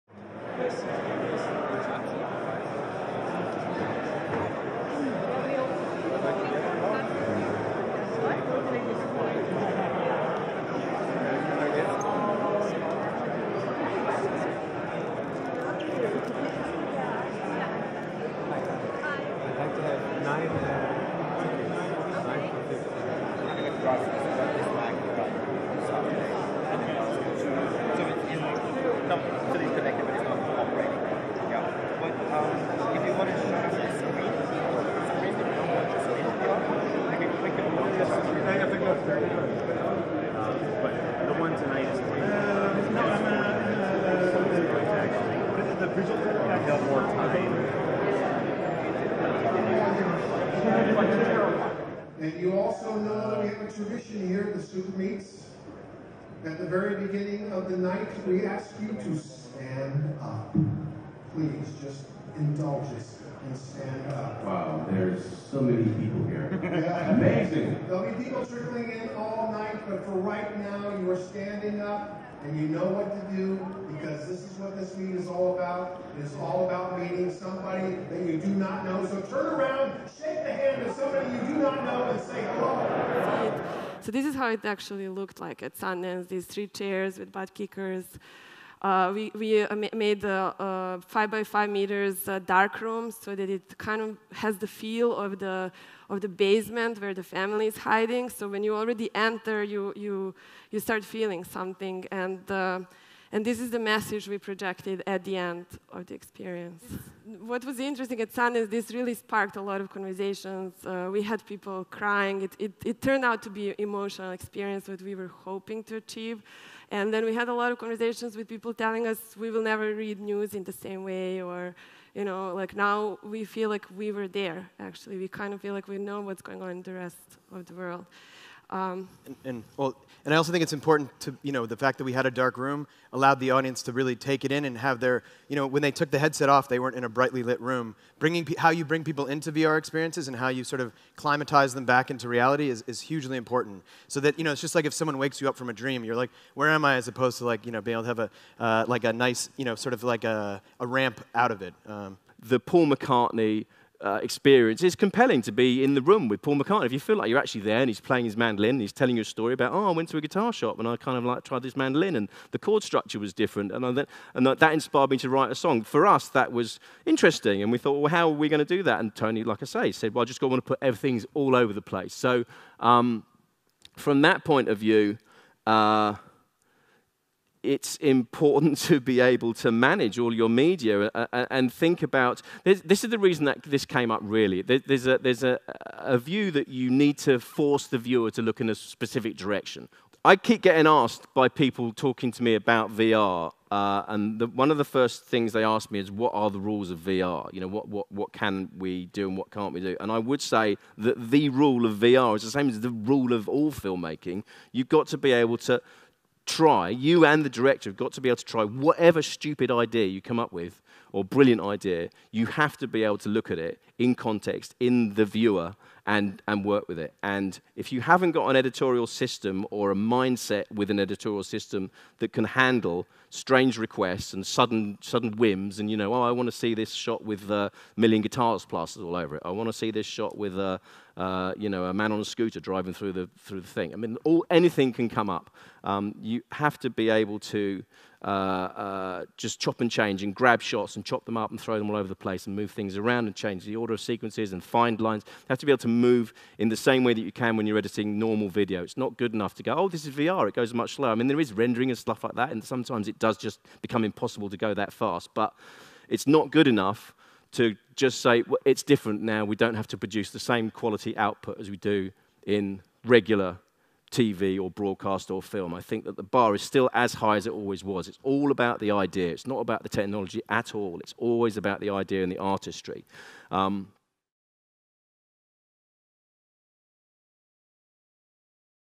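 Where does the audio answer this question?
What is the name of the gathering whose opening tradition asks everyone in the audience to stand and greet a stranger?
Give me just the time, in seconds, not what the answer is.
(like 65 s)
54 s.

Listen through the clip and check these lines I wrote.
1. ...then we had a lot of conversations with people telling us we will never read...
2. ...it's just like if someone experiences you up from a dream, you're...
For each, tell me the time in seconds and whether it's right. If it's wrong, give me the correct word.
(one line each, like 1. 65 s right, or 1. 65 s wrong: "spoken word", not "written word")
1. 117 s right
2. 144 s wrong: "wakes", not "experiences".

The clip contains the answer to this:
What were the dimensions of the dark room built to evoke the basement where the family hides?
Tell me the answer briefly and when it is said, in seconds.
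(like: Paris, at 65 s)
5 by 5 meters, at 91 s.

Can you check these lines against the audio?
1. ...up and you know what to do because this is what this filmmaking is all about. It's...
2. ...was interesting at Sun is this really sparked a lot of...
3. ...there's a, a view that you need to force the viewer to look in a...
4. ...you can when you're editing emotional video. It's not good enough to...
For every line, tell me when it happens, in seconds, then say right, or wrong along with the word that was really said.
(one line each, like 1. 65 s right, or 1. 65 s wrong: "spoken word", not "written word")
1. 71 s wrong: "meeting", not "filmmaking"
2. 107 s right
3. 185 s right
4. 247 s wrong: "normal", not "emotional".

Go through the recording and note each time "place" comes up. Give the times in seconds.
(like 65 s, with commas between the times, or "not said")
171 s, 242 s.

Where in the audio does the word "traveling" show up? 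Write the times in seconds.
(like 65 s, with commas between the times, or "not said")
not said.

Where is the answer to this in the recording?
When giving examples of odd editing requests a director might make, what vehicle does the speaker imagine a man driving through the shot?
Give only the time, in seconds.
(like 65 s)
232 s.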